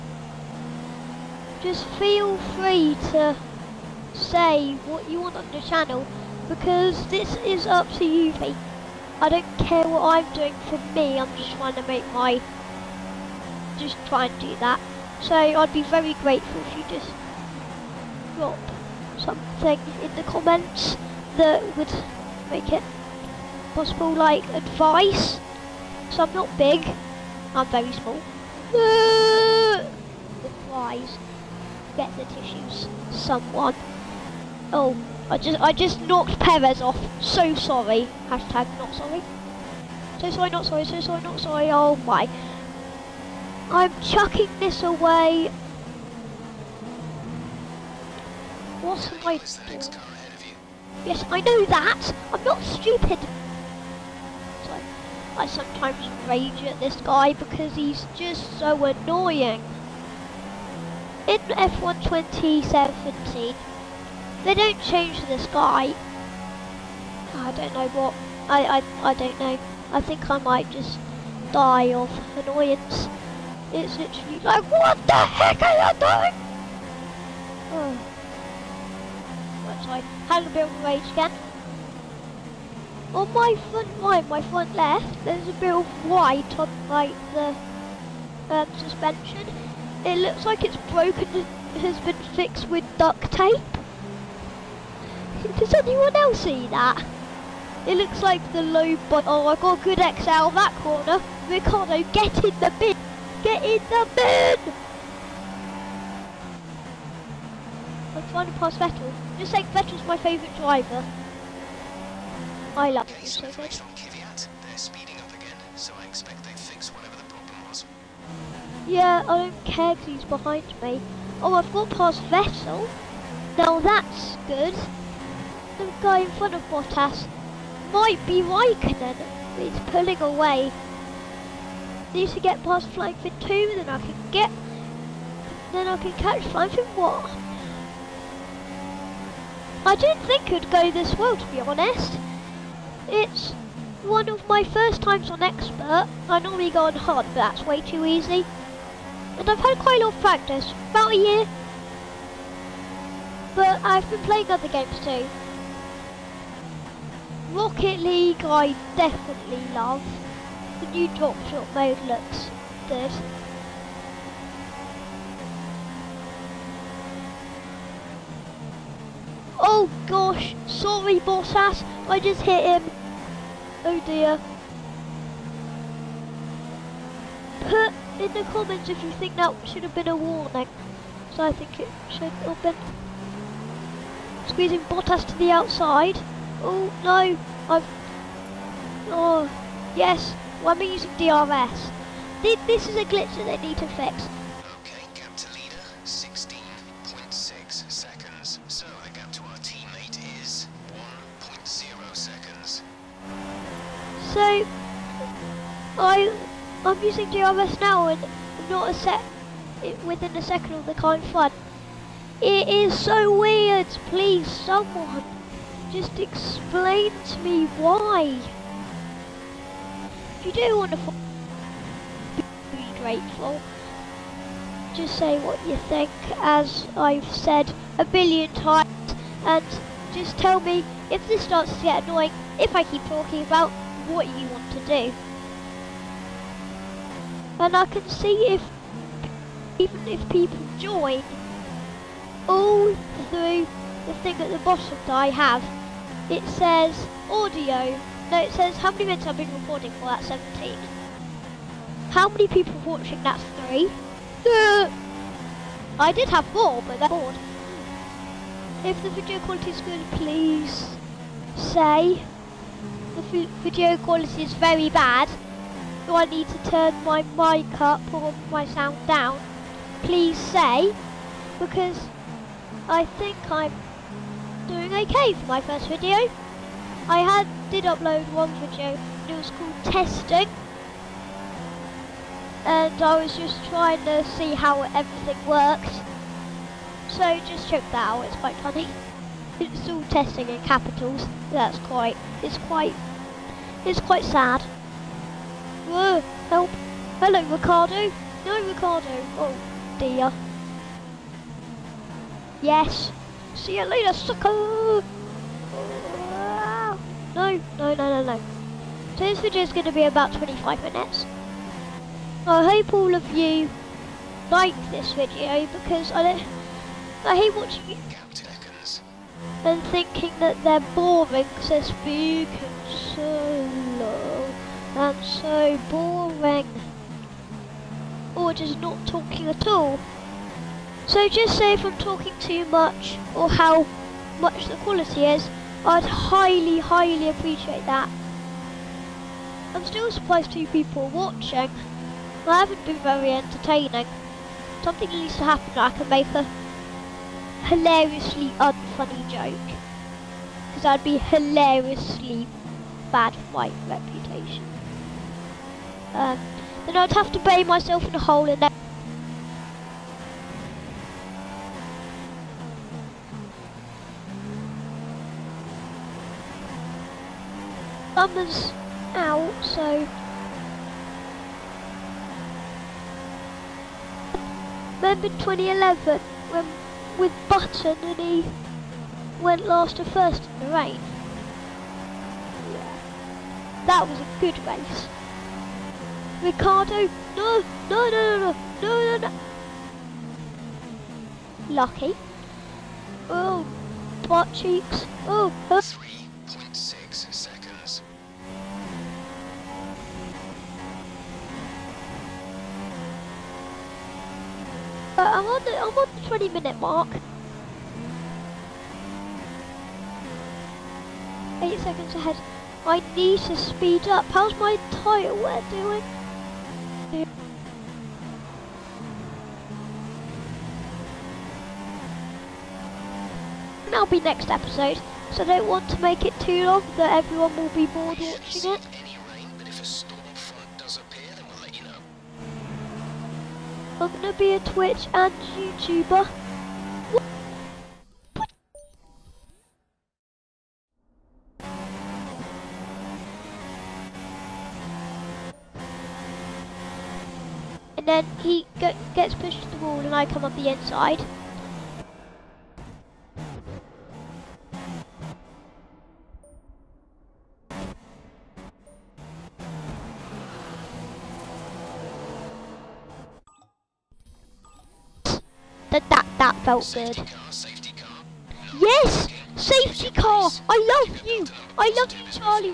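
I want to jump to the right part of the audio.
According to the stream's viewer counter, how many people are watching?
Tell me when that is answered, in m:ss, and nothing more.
4:13.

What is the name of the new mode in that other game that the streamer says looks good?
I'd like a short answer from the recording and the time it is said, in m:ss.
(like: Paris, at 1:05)
Drop shot, at 2:41.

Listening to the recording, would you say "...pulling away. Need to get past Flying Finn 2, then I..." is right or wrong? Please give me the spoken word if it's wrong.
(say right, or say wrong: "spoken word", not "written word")
right.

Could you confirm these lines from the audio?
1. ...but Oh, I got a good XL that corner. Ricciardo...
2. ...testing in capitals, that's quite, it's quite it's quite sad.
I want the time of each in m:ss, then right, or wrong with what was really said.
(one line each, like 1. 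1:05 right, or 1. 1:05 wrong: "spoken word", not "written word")
1. 1:39 right
2. 4:50 right.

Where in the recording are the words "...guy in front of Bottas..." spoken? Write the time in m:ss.
2:06.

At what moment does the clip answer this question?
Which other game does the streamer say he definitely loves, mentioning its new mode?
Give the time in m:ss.
2:37.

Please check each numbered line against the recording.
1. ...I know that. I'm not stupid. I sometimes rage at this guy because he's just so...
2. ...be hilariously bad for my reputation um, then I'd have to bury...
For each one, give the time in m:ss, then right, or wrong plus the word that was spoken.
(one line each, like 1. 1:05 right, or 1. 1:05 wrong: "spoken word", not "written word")
1. 0:51 right
2. 5:51 right.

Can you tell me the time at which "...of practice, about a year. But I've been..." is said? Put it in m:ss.
2:30.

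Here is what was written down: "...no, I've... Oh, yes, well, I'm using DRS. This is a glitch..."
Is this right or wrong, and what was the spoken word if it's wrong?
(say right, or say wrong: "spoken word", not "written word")
right.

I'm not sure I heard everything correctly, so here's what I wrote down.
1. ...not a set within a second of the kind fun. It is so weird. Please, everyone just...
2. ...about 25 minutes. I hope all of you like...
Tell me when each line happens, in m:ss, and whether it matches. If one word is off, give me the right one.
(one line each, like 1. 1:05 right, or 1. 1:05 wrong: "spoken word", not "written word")
1. 3:28 wrong: "someone", not "everyone"
2. 5:10 right.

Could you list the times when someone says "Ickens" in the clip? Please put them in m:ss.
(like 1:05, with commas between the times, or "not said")
5:18.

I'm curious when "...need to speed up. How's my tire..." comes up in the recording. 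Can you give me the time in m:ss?
6:53.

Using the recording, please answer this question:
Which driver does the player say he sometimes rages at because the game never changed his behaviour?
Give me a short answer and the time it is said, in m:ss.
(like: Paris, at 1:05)
Perez, at 0:36.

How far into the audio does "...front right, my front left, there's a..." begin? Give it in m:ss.
1:23.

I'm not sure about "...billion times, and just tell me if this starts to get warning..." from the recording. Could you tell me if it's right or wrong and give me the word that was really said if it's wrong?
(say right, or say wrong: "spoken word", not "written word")
wrong: "annoying", not "warning".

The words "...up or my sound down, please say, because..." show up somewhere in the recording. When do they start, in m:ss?
4:27.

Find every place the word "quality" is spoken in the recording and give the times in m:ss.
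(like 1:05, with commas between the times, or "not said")
4:19, 4:23, 5:34.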